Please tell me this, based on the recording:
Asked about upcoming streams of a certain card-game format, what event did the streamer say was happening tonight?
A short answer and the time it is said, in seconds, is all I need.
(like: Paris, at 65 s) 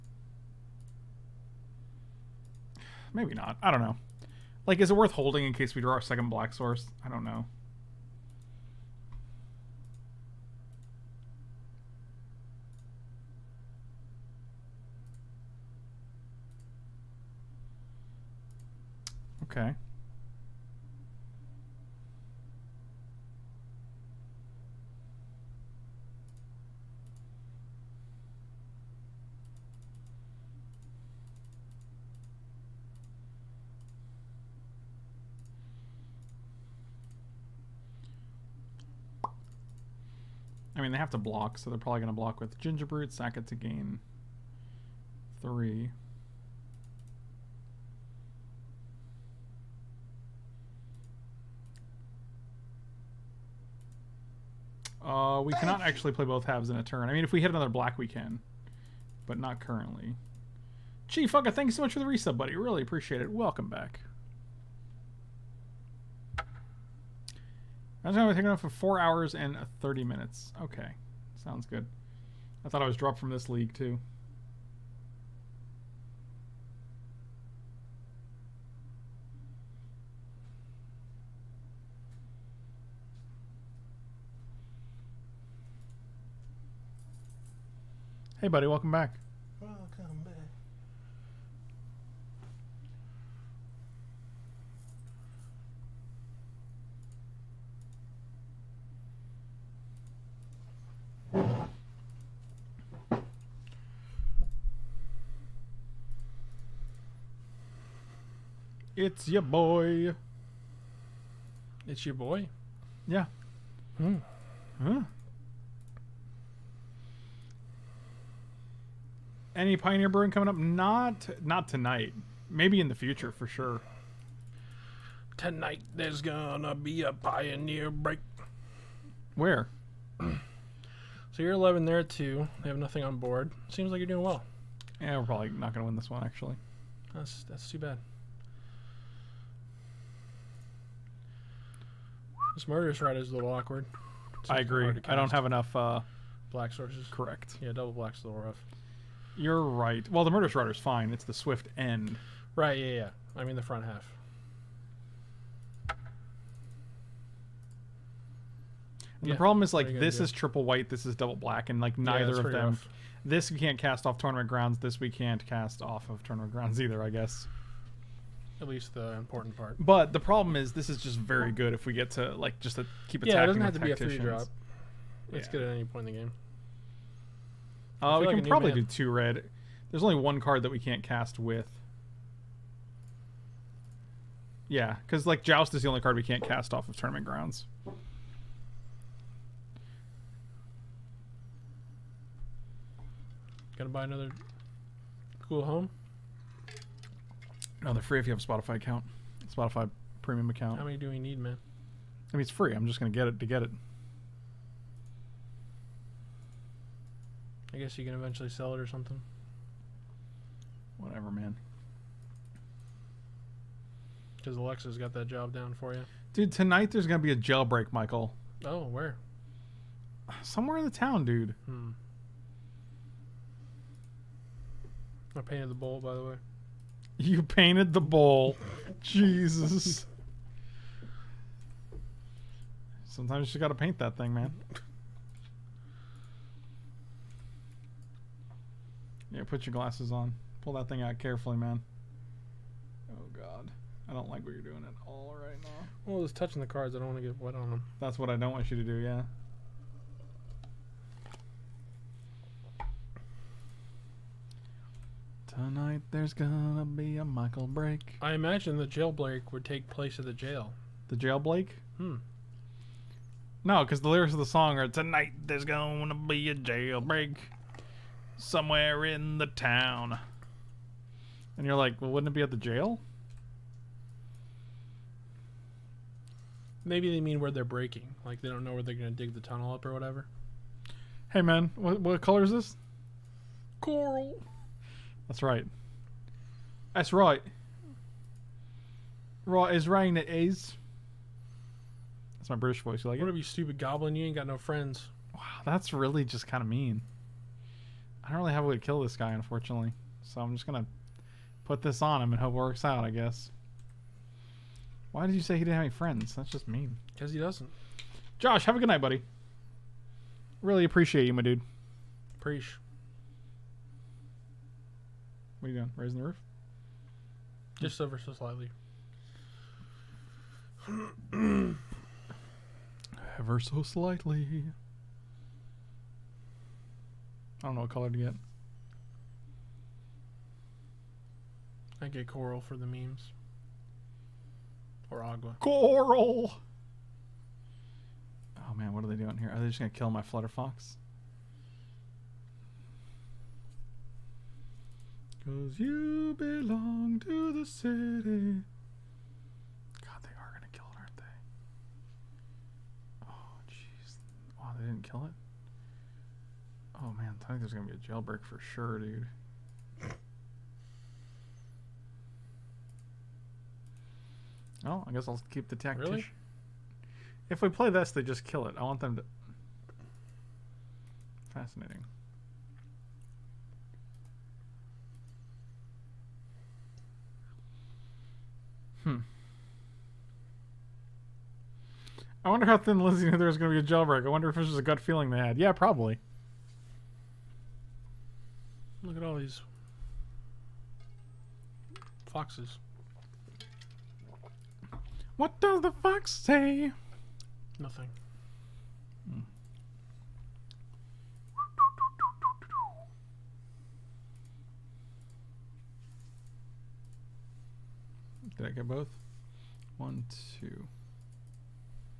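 Pioneer break, at 127 s.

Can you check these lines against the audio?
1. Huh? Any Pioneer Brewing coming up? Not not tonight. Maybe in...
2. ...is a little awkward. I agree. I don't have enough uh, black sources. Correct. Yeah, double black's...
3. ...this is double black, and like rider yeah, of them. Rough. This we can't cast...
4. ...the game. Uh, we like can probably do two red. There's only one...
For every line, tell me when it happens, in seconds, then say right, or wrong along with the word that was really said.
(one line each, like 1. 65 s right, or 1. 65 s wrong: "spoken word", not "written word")
1. 114 s right
2. 143 s right
3. 160 s wrong: "neither", not "rider"
4. 176 s right.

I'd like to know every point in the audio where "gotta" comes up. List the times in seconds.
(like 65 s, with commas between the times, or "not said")
233 s.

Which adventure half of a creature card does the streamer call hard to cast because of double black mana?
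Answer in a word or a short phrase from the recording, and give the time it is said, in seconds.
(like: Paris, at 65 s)
Swift End, at 151 s.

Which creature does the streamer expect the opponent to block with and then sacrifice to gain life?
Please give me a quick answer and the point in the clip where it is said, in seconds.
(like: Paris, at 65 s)
Gingerbrute, at 42 s.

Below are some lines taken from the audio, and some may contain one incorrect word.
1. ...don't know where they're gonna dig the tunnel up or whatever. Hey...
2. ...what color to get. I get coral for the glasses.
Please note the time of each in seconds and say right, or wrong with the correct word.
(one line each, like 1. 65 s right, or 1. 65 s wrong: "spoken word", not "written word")
1. 278 s right
2. 327 s wrong: "memes", not "glasses".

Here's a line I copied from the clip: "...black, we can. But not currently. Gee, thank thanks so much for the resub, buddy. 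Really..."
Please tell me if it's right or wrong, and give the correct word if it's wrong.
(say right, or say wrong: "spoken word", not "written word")
right.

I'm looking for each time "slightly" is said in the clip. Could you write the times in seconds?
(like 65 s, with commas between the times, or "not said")
318 s, 323 s.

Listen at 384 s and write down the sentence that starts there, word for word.
I wonder if this was a gut feeling they had.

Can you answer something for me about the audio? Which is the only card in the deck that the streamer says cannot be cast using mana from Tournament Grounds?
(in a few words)
Joust.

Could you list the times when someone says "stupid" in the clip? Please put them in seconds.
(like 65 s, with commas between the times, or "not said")
293 s.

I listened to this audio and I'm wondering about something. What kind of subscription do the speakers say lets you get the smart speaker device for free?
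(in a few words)
Spotify Premium.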